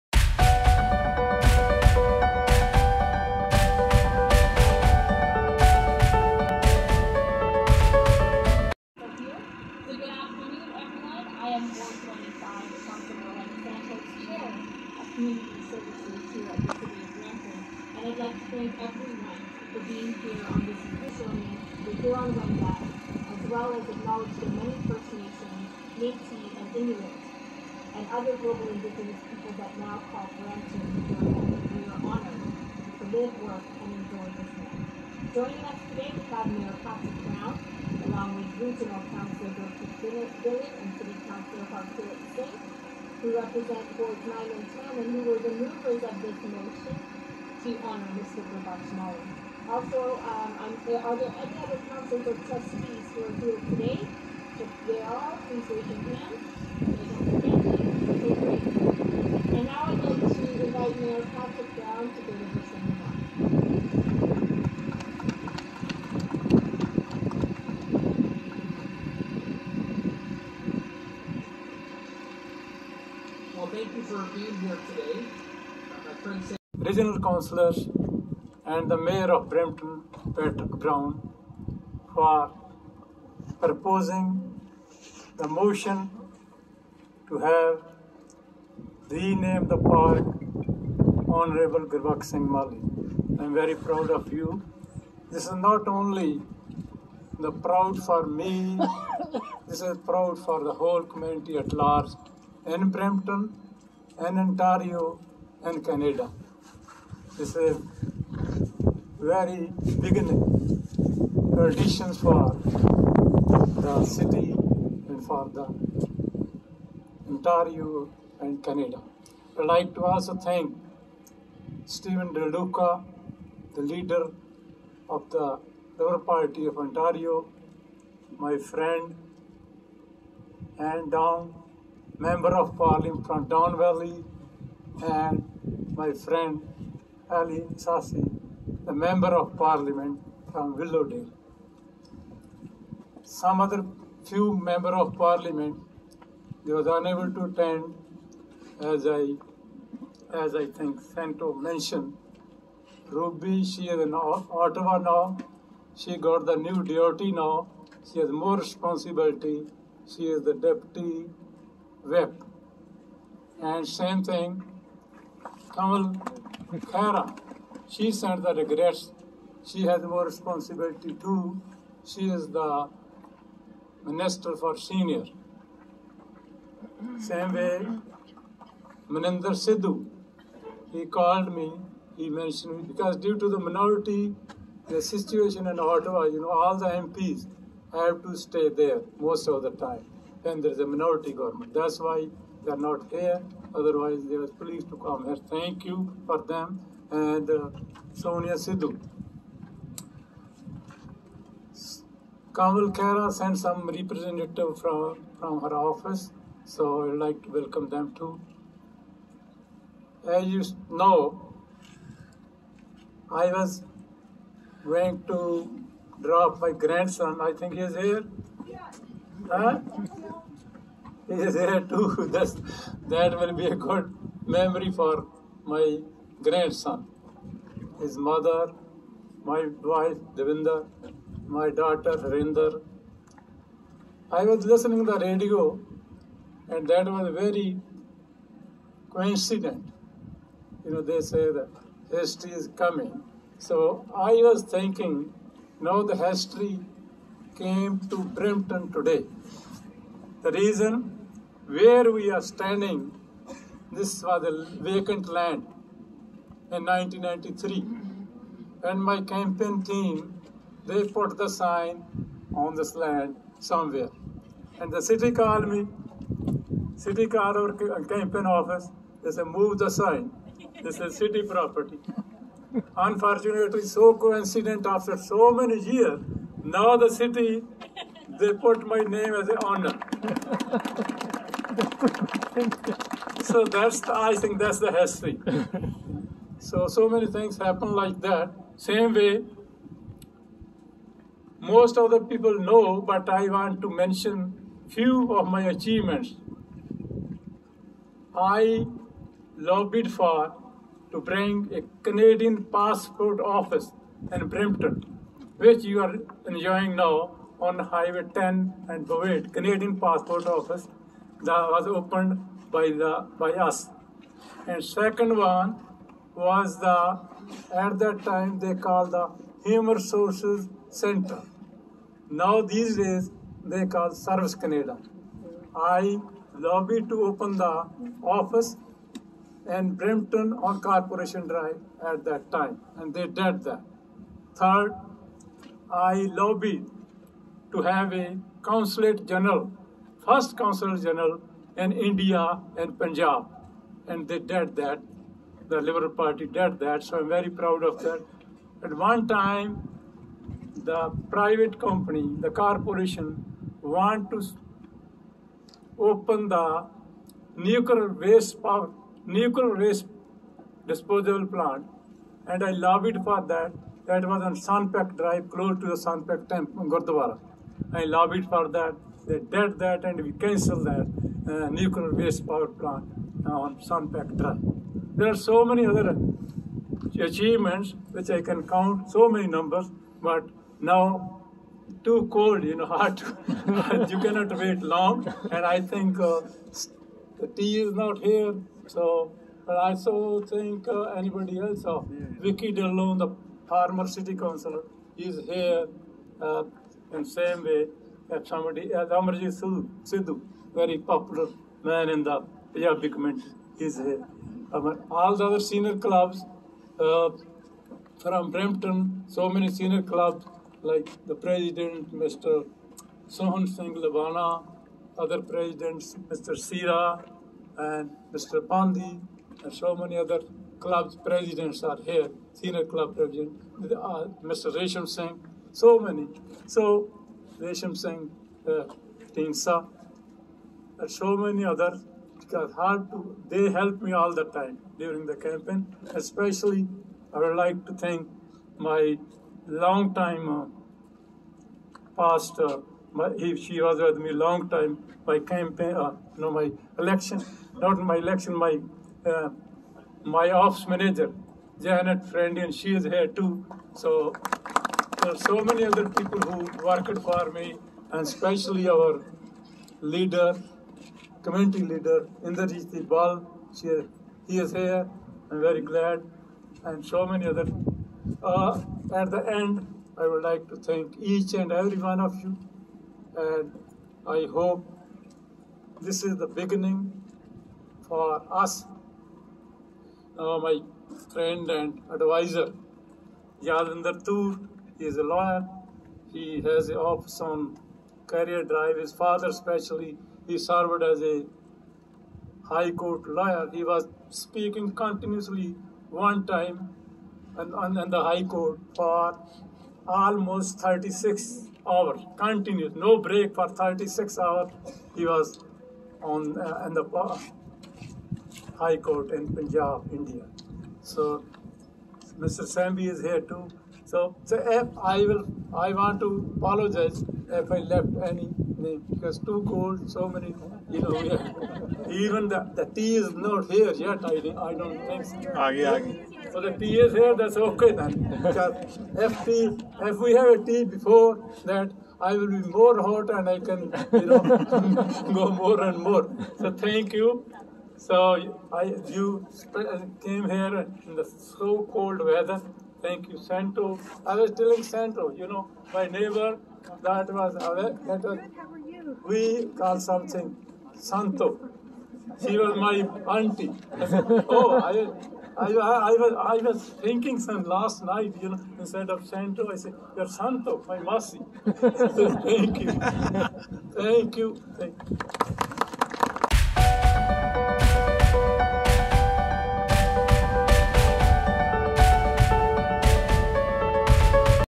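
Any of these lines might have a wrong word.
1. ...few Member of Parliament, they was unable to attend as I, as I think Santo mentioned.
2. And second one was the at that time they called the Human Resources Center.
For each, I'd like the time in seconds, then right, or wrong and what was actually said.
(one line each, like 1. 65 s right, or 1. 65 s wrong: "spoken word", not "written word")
1. 144 s right
2. 314 s right.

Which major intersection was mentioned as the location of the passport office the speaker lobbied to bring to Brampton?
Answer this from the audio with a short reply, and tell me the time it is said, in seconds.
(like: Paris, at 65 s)
Highway 10 and Bovaird, at 307 s.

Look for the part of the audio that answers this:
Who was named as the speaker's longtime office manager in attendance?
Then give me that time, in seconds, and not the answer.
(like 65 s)
451 s.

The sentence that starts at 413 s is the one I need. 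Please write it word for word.
Sohan Singh Lavana, other presidents, Mr.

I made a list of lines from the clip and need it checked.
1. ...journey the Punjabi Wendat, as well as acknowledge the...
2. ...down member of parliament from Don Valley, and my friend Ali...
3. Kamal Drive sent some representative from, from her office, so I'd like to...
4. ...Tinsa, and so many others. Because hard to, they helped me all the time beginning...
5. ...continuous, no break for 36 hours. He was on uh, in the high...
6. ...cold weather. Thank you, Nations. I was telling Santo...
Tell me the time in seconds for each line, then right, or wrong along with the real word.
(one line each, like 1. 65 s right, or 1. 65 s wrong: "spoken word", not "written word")
1. 21 s wrong: "Huron", not "Punjabi"
2. 131 s right
3. 202 s wrong: "Khera", not "Drive"
4. 429 s wrong: "during", not "beginning"
5. 502 s right
6. 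541 s wrong: "Santo", not "Nations".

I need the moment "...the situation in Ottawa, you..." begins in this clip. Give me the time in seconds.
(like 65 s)
184 s.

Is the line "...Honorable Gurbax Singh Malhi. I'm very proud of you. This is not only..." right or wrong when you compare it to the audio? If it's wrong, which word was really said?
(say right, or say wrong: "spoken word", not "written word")
right.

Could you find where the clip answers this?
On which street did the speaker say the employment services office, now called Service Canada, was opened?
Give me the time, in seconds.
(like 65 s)
330 s.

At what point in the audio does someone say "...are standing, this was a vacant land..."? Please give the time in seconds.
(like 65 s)
252 s.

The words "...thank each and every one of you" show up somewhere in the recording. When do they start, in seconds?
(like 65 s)
470 s.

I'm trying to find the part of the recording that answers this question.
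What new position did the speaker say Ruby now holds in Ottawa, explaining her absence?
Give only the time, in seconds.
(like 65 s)
160 s.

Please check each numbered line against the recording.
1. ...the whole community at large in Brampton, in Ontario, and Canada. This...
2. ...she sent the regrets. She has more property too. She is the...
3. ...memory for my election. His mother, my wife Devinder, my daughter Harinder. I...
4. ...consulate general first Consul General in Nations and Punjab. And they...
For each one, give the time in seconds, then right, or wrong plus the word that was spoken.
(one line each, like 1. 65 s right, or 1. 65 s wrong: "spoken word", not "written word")
1. 100 s right
2. 167 s wrong: "responsibility", not "property"
3. 224 s wrong: "grandson", not "election"
4. 338 s wrong: "India", not "Nations".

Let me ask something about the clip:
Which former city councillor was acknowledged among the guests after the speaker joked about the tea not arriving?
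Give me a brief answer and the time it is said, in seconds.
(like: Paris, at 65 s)
Vicky Dhillon, at 392 s.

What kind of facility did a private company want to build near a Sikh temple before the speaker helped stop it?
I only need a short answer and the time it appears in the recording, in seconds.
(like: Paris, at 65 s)
Nuclear waste disposal plant, at 359 s.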